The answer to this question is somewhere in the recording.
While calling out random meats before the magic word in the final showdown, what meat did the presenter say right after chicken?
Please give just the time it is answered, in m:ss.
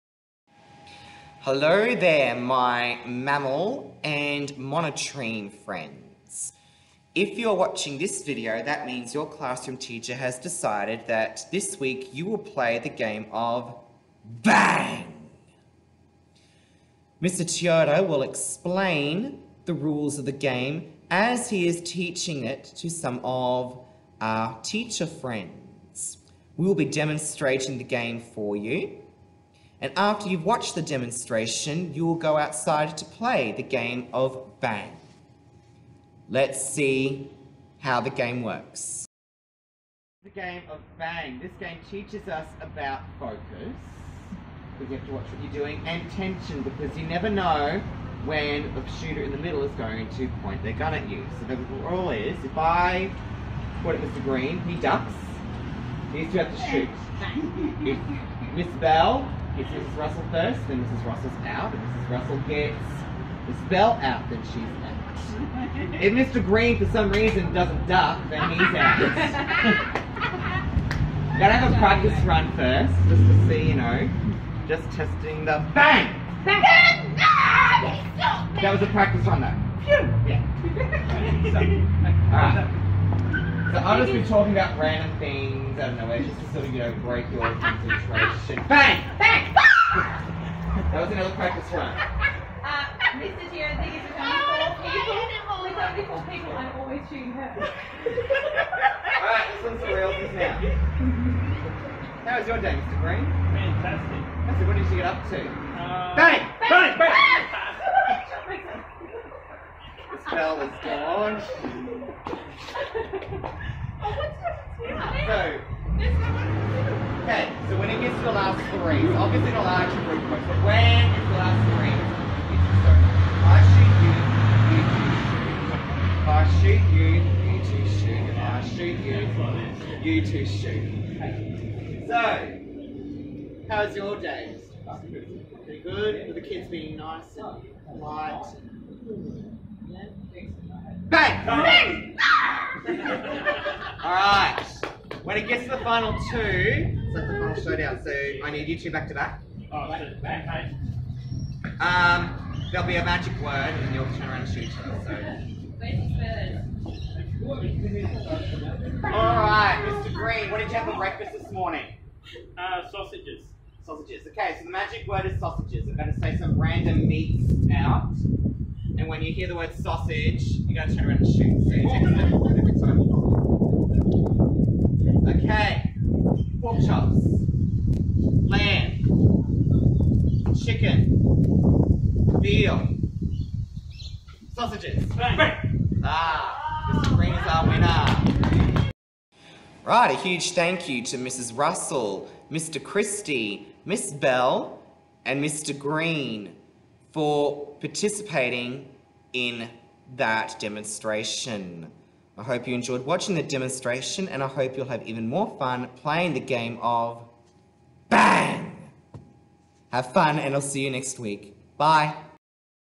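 3:02.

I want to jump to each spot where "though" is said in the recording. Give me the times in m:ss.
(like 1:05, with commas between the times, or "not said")
1:19.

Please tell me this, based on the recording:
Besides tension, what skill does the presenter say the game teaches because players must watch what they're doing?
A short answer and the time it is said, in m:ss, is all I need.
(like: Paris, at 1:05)
Focus, at 0:43.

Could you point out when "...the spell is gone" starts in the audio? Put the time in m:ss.
1:50.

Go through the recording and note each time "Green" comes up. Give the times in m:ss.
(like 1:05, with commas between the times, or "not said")
0:54, 1:06, 1:42, 2:40, 3:15.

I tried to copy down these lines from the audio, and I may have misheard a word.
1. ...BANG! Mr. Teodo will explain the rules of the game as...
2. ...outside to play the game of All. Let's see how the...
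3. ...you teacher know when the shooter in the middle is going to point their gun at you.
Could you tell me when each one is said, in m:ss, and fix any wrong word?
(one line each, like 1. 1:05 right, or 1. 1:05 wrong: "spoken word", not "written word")
1. 0:14 right
2. 0:32 wrong: "Bang", not "All"
3. 0:46 wrong: "never", not "teacher".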